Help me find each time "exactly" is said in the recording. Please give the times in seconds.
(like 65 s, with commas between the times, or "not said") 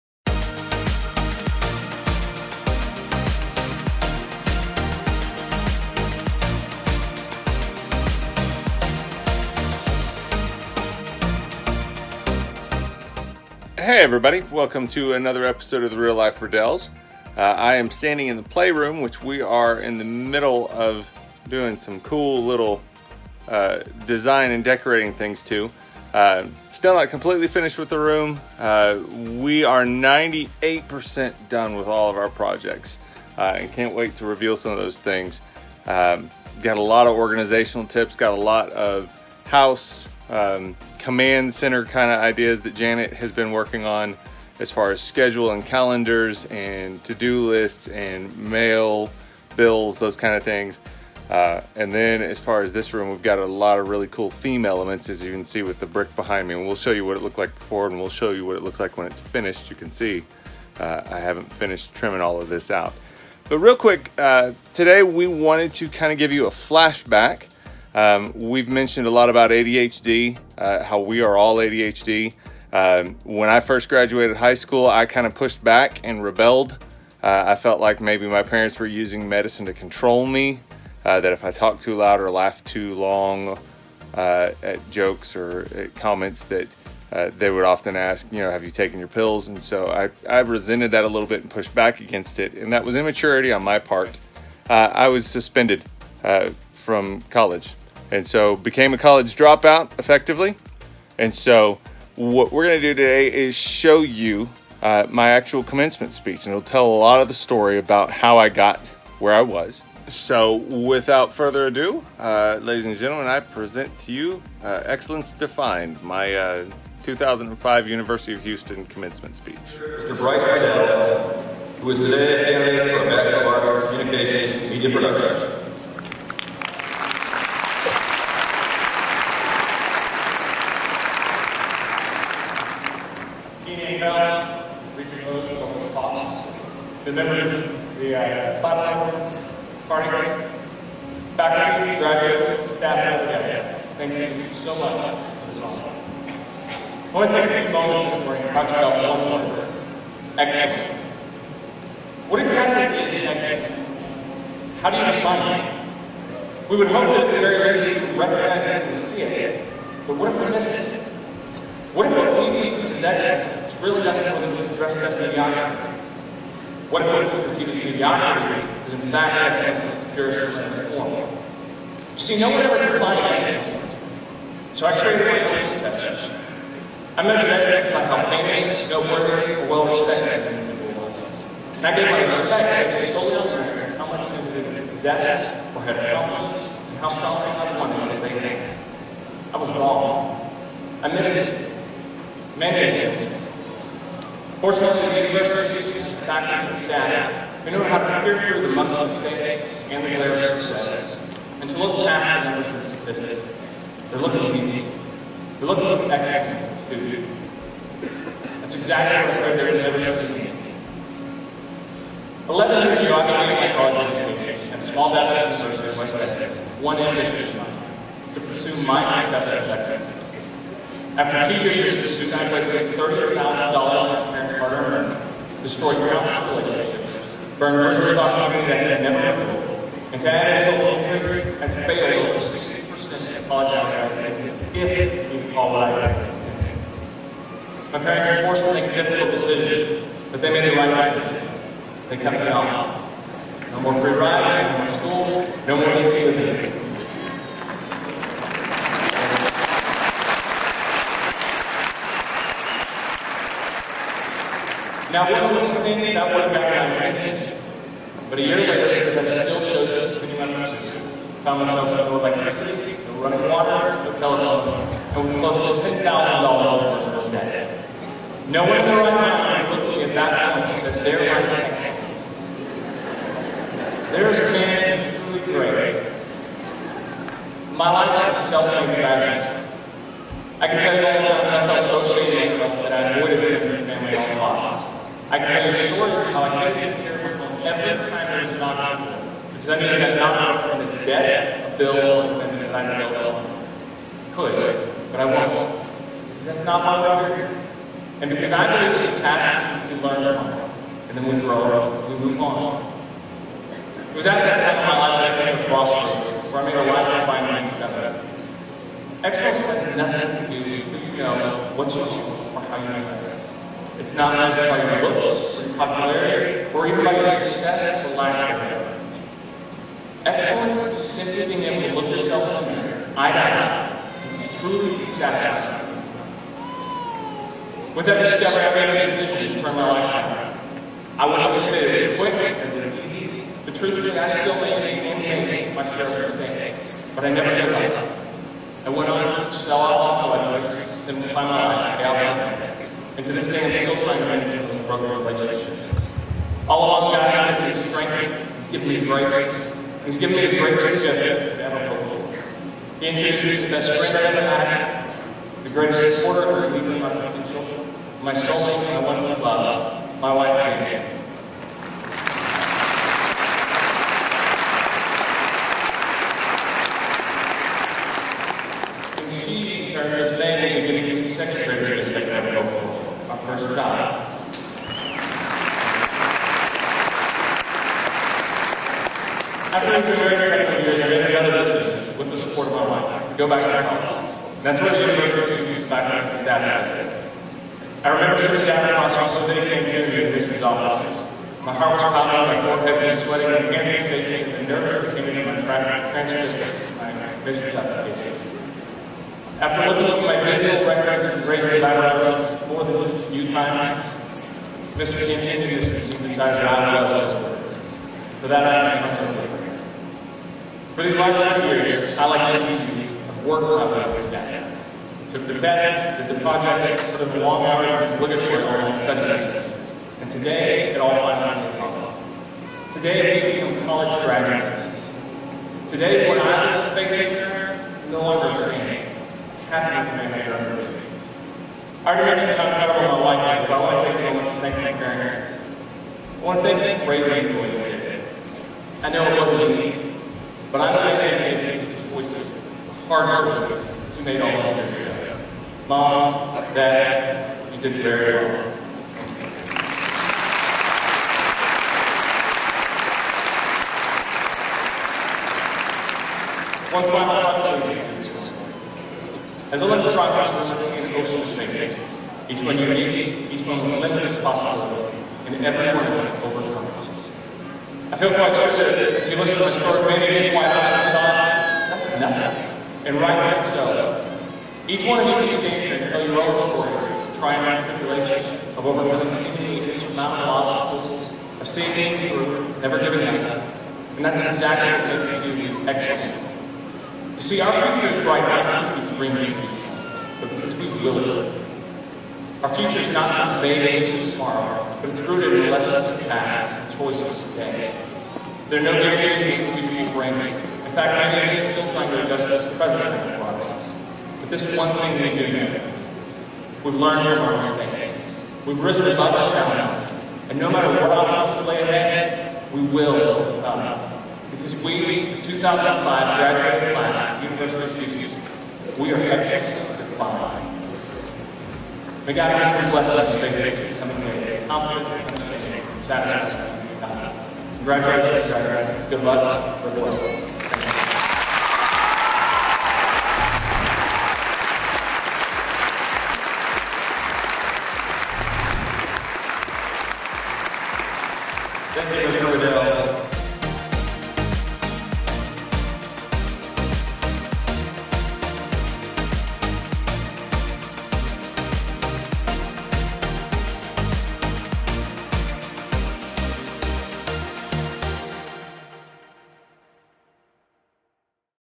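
152 s, 208 s, 484 s.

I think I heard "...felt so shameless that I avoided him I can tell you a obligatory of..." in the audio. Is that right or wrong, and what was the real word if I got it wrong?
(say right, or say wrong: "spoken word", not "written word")
wrong: "story", not "obligatory".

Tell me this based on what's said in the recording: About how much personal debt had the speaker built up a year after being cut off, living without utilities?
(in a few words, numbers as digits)
$10,000.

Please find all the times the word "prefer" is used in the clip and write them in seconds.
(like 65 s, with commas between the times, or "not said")
not said.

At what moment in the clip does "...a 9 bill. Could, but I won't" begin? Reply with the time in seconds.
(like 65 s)
292 s.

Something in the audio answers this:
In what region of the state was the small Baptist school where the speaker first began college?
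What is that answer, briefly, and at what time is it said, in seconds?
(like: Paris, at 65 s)
West Texas, at 215 s.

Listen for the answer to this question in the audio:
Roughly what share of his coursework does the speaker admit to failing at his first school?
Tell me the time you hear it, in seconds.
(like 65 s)
232 s.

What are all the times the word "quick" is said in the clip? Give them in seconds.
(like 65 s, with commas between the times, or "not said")
63 s, 332 s.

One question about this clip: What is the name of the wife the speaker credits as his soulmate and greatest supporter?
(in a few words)
Anne.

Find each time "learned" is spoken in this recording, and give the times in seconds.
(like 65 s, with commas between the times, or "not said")
300 s, 506 s.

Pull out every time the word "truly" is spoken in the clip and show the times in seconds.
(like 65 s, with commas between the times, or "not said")
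275 s, 324 s.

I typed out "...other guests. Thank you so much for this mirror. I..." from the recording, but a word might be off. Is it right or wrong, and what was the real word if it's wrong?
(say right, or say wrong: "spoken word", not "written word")
wrong: "honor", not "mirror".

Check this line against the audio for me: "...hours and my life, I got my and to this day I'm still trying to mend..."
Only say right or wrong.
wrong.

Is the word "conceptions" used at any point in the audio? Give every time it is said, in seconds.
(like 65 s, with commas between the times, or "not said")
175 s, 219 s.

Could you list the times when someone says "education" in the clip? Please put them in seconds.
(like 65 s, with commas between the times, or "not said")
214 s.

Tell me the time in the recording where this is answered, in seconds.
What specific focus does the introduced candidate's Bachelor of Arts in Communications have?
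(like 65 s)
124 s.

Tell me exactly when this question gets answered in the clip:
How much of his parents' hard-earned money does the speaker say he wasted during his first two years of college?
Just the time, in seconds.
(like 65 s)
222 s.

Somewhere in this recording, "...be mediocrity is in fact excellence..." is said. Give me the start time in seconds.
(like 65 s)
167 s.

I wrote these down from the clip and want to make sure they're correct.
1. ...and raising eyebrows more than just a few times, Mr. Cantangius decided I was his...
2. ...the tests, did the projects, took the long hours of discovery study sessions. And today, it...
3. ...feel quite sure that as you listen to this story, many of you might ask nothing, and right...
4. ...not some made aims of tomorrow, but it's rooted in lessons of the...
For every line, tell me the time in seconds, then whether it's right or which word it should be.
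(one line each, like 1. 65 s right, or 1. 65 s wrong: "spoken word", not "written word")
1. 401 s right
2. 415 s wrong: "obligatory", not "discovery"
3. 468 s right
4. 493 s right.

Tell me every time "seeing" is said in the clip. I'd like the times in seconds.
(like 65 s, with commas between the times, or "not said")
210 s, 481 s.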